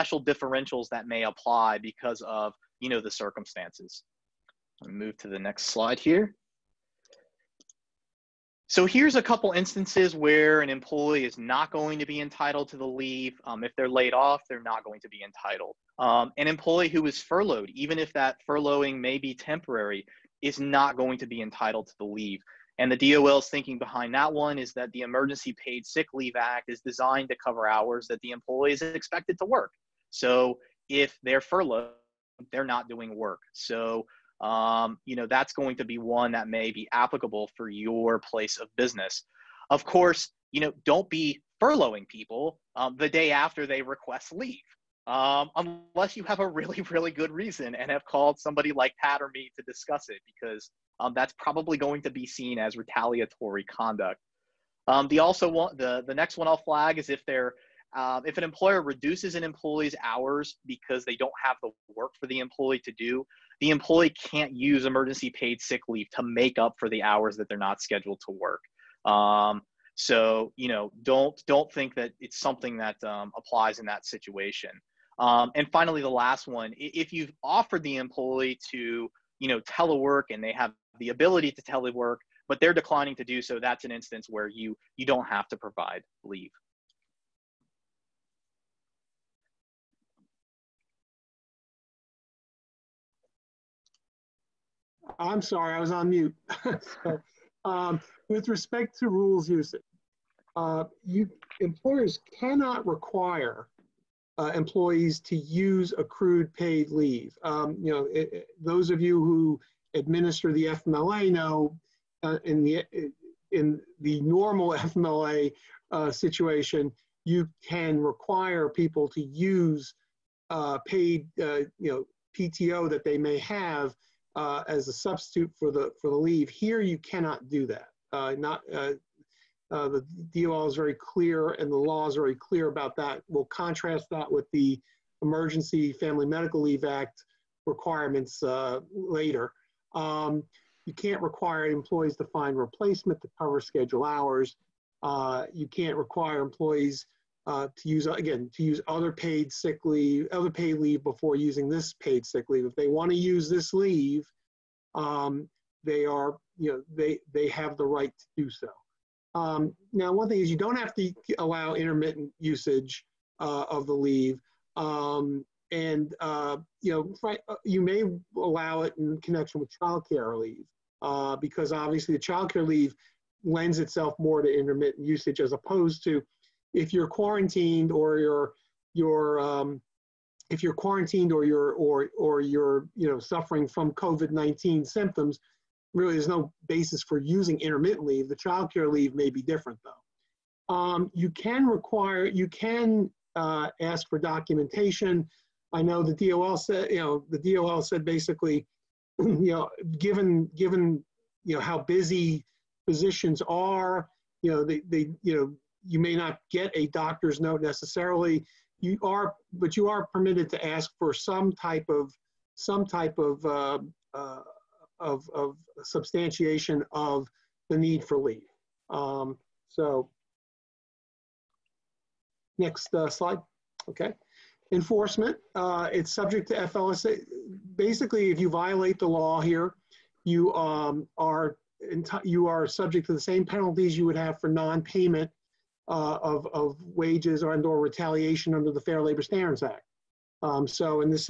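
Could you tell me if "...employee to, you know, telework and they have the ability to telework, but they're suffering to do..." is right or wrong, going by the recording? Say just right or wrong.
wrong.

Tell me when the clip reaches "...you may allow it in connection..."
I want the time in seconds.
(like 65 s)
167 s.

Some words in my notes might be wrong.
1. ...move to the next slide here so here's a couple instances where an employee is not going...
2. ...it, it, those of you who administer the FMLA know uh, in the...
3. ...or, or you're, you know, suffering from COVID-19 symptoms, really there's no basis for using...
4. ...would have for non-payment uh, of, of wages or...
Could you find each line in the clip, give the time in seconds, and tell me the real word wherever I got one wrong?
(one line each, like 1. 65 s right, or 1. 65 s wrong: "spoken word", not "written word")
1. 4 s right
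2. 108 s right
3. 181 s right
4. 234 s right.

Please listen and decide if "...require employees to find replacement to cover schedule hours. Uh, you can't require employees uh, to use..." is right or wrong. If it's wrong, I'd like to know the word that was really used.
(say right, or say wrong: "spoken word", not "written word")
right.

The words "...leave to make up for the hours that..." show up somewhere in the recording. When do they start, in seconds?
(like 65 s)
65 s.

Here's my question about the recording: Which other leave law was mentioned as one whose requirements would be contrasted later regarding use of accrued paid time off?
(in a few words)
Emergency Family Medical Leave Act.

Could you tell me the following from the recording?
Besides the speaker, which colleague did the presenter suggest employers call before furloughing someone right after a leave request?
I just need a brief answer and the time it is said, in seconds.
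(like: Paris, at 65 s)
Pat, at 49 s.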